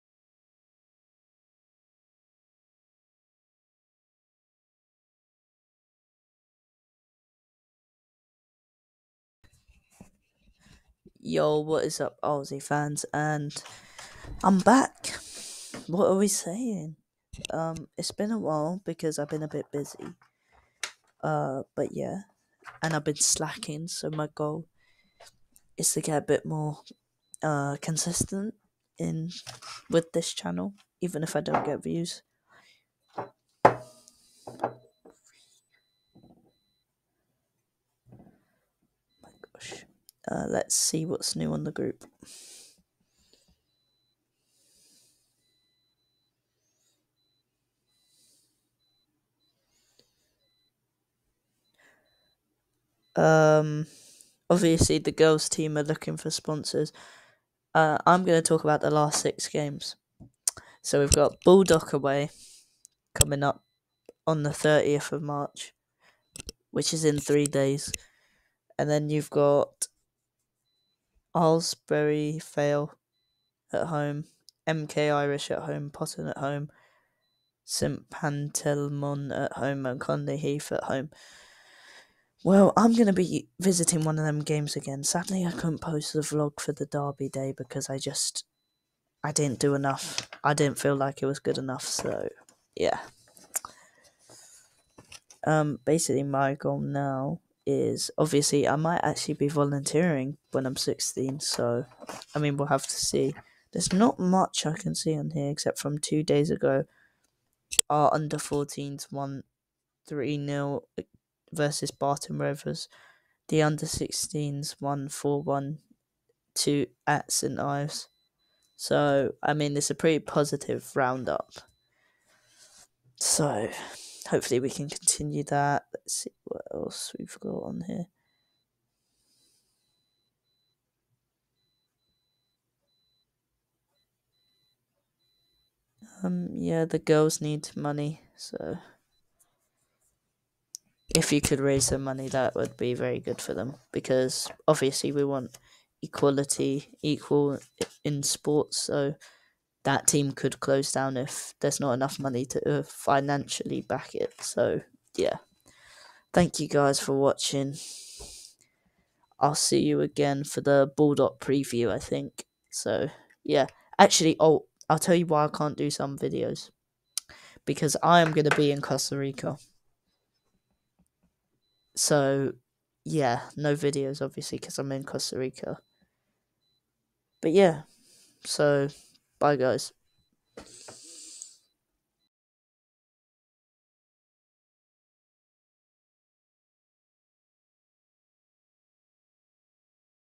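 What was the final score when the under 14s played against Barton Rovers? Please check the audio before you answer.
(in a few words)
3-0.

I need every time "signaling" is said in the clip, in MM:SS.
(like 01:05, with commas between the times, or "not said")
not said.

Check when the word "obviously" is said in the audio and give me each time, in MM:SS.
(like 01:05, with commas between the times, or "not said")
00:54, 01:38, 02:24, 02:54.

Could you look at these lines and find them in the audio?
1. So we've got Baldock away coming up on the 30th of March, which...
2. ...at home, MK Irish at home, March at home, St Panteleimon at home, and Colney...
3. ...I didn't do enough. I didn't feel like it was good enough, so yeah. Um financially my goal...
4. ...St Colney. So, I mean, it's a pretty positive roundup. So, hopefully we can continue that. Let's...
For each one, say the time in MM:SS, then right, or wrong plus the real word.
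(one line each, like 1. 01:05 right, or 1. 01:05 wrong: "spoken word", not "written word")
1. 01:00 right
2. 01:13 wrong: "Potton", not "March"
3. 01:29 wrong: "basically", not "financially"
4. 01:57 wrong: "Ives", not "Colney".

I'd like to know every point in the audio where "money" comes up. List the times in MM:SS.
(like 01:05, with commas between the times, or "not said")
02:17, 02:22, 02:32.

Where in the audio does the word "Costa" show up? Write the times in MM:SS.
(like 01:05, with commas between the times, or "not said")
02:48, 02:55.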